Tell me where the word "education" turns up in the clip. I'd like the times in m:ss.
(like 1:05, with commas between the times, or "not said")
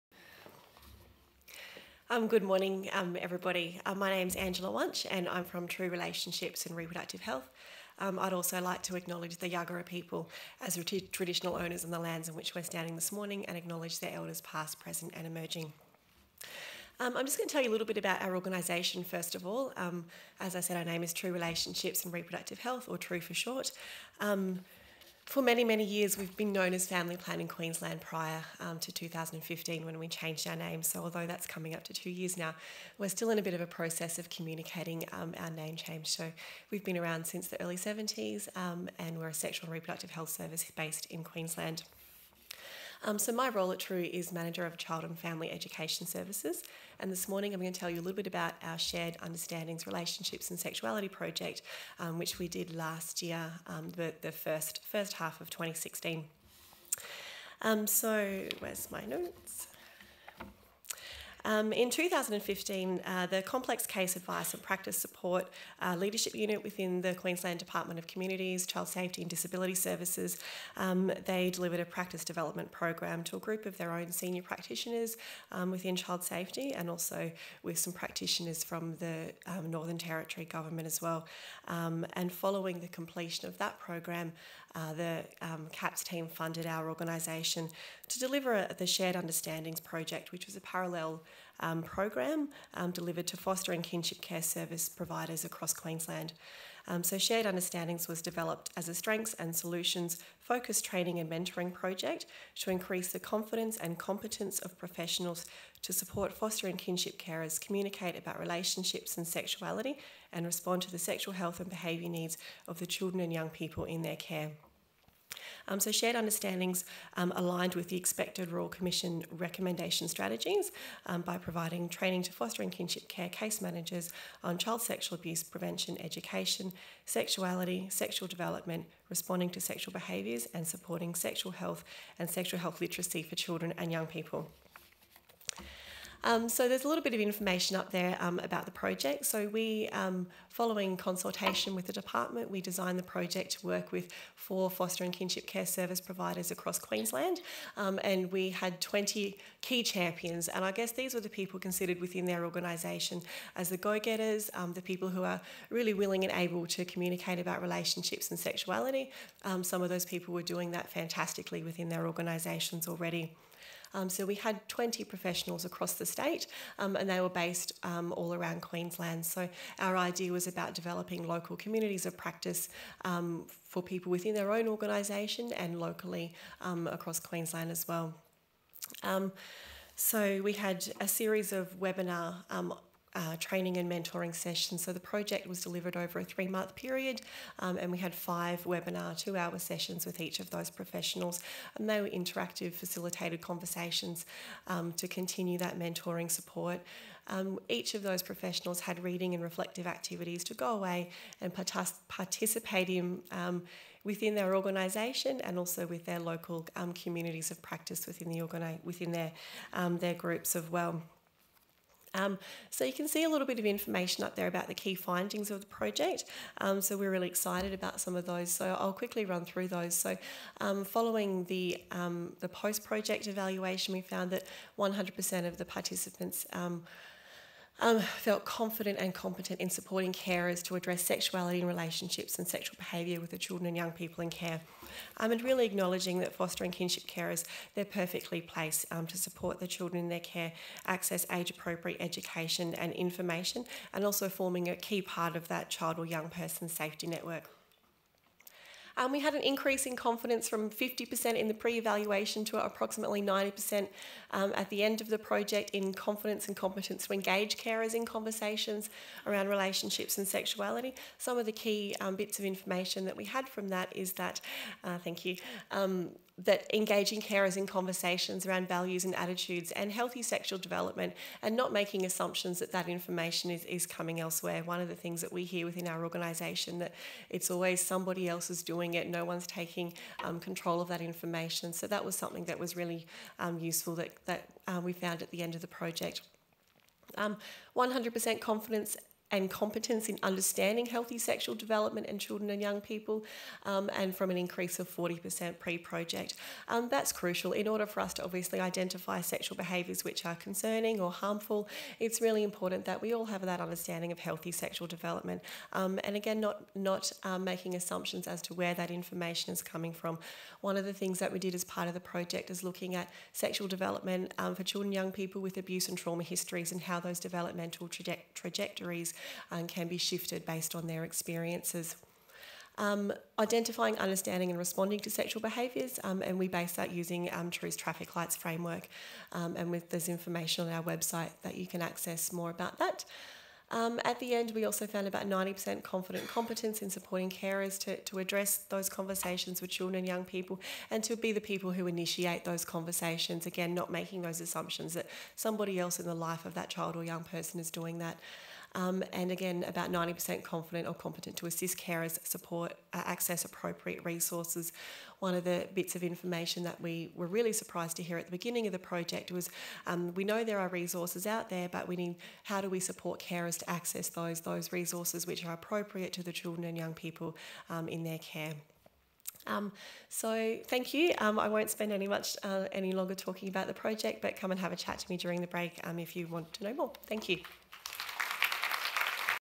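0:45, 2:06, 4:02.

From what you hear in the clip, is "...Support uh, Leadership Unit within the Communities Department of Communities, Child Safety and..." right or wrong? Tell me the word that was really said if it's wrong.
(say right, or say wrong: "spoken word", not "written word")
wrong: "Queensland", not "Communities".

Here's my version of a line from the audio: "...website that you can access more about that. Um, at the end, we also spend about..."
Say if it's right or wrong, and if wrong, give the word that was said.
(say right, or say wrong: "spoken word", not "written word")
wrong: "found", not "spend".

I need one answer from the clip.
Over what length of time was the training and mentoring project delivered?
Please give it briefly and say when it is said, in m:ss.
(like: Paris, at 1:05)
3 months, at 3:06.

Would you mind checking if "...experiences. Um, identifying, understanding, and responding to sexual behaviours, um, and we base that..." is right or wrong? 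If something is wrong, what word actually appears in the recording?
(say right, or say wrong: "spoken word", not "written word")
right.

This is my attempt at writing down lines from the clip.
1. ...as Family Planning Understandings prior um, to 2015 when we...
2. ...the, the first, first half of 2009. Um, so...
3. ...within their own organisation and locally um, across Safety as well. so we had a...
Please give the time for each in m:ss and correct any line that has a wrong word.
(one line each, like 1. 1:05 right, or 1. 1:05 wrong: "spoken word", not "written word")
1. 0:26 wrong: "Queensland", not "Understandings"
2. 0:53 wrong: "2016", not "2009"
3. 2:54 wrong: "Queensland", not "Safety".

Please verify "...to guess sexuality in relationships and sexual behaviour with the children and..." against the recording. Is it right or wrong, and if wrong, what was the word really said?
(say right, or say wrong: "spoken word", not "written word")
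wrong: "address", not "guess".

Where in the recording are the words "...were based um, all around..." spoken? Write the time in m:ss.
2:47.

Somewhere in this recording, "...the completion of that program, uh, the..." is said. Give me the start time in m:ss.
1:22.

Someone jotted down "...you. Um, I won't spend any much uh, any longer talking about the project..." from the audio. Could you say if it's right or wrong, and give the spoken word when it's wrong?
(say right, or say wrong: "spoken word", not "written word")
right.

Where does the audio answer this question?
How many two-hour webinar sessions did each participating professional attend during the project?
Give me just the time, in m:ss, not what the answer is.
3:08.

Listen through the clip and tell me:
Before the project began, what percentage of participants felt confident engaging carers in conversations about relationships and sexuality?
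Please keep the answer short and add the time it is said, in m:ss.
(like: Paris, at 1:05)
50%, at 4:10.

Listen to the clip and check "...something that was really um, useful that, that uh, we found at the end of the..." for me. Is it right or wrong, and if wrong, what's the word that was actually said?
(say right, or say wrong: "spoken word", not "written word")
right.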